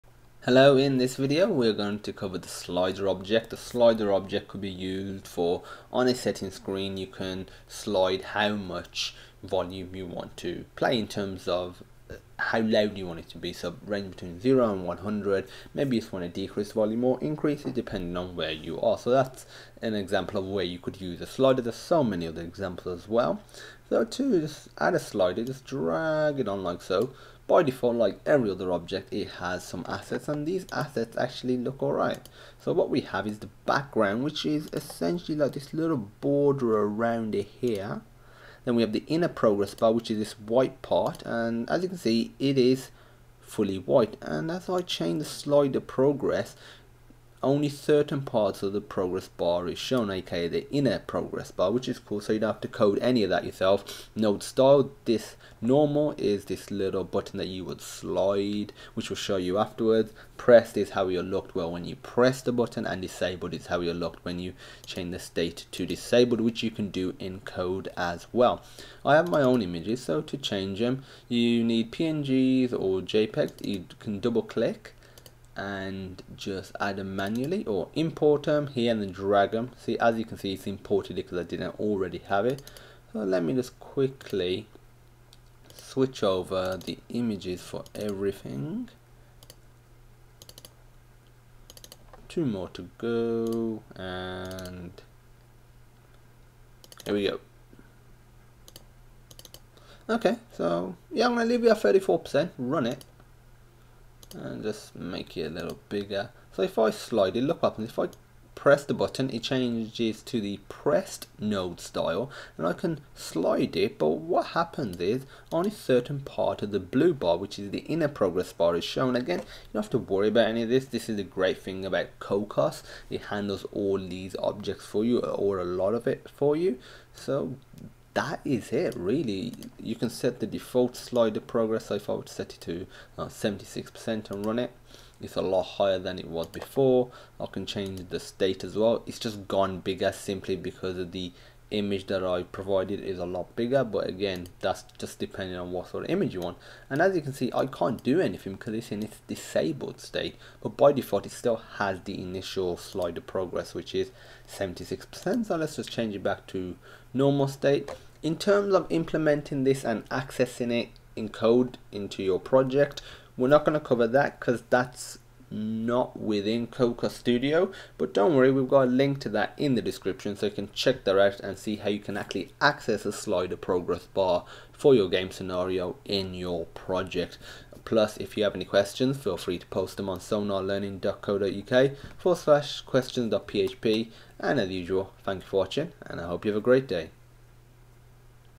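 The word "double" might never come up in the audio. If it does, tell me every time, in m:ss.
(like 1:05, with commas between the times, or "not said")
1:14.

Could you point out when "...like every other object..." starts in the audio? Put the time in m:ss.
0:27.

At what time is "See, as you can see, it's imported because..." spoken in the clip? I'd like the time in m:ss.
1:19.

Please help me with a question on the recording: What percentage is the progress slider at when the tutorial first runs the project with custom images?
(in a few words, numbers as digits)
34%.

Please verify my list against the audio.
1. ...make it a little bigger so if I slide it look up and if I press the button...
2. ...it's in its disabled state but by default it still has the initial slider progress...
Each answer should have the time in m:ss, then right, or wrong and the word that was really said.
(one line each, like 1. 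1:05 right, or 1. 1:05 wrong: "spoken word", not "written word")
1. 1:44 right
2. 2:28 right.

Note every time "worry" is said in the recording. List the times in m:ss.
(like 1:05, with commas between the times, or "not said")
1:59, 2:48.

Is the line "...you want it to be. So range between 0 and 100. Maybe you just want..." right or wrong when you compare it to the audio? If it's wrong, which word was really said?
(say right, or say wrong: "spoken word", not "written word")
right.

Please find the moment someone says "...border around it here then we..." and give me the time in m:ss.
0:36.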